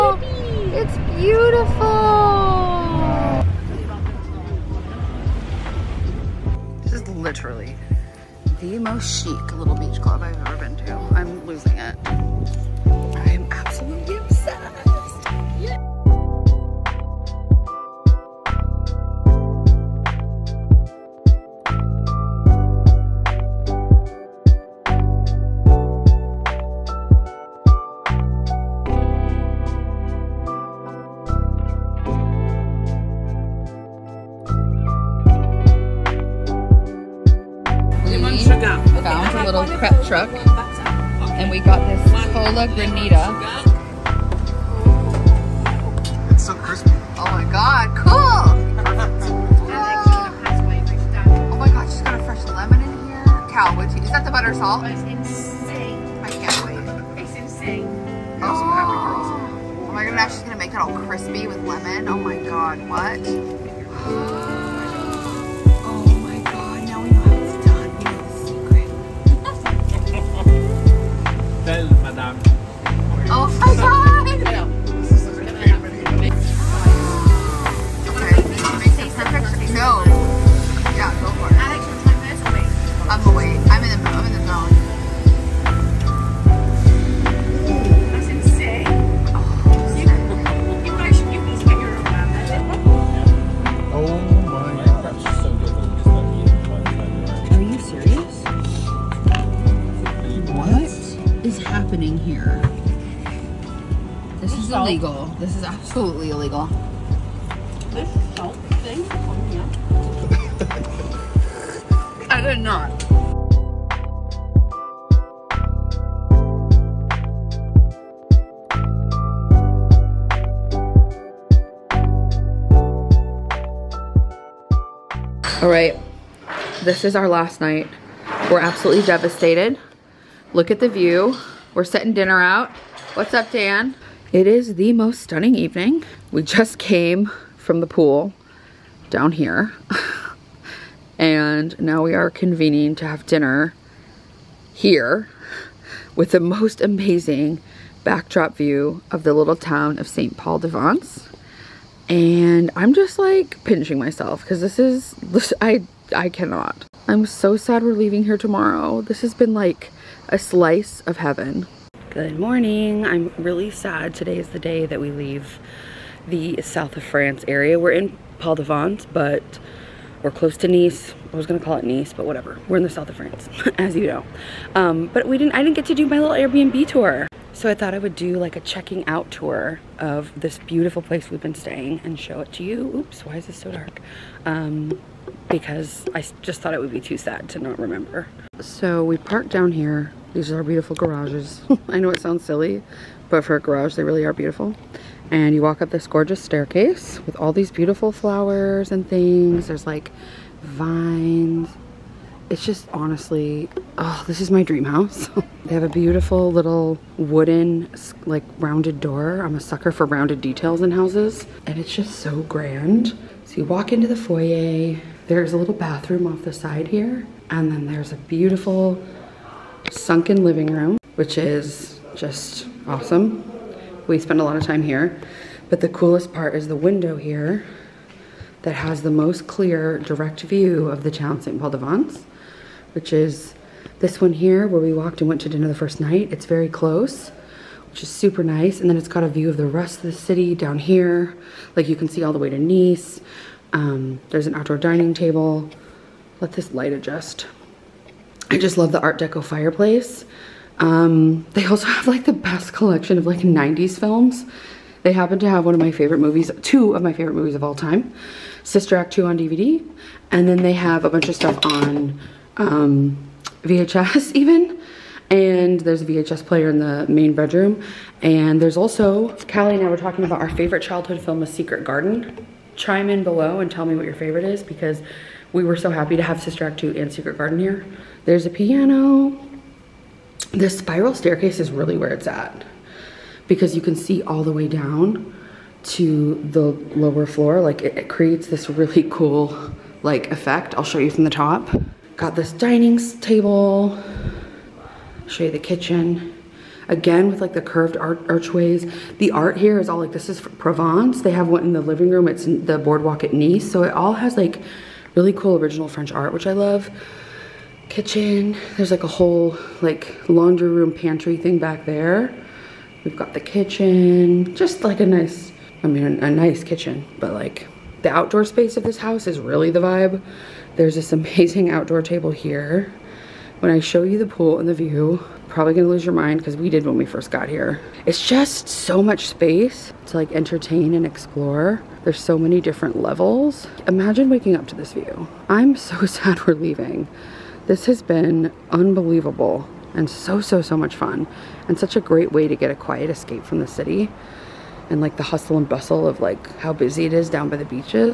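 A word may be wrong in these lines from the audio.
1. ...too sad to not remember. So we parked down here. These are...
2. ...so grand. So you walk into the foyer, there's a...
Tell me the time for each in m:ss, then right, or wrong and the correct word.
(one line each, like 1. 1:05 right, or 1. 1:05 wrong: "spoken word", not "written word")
1. 3:07 right
2. 3:32 right.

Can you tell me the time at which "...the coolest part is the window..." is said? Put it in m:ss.
3:45.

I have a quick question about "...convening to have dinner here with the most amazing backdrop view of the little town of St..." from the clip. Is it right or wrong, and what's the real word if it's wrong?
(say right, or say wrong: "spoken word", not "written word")
right.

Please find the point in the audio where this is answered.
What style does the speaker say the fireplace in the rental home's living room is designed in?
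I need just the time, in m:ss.
4:09.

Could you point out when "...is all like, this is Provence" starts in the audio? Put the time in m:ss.
4:59.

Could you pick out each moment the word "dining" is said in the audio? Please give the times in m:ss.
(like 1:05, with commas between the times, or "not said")
4:04, 4:52.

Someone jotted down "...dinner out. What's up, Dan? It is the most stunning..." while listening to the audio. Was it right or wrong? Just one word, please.
right.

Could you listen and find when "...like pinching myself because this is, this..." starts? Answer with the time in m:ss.
2:33.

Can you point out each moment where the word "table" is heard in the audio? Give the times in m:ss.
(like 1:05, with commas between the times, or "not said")
4:05, 4:53, 5:22.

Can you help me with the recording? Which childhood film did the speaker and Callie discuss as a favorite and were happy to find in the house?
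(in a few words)
A Secret Garden.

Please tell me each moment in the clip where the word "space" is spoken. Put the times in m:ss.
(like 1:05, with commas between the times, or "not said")
5:18, 5:29.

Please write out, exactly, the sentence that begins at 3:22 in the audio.
It's just honestly, oh, this is my dream house.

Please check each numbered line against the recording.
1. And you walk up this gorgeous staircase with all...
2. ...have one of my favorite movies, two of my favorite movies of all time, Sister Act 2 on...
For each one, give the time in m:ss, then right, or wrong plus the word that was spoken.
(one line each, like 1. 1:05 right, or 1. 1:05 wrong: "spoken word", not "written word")
1. 3:15 right
2. 4:15 right.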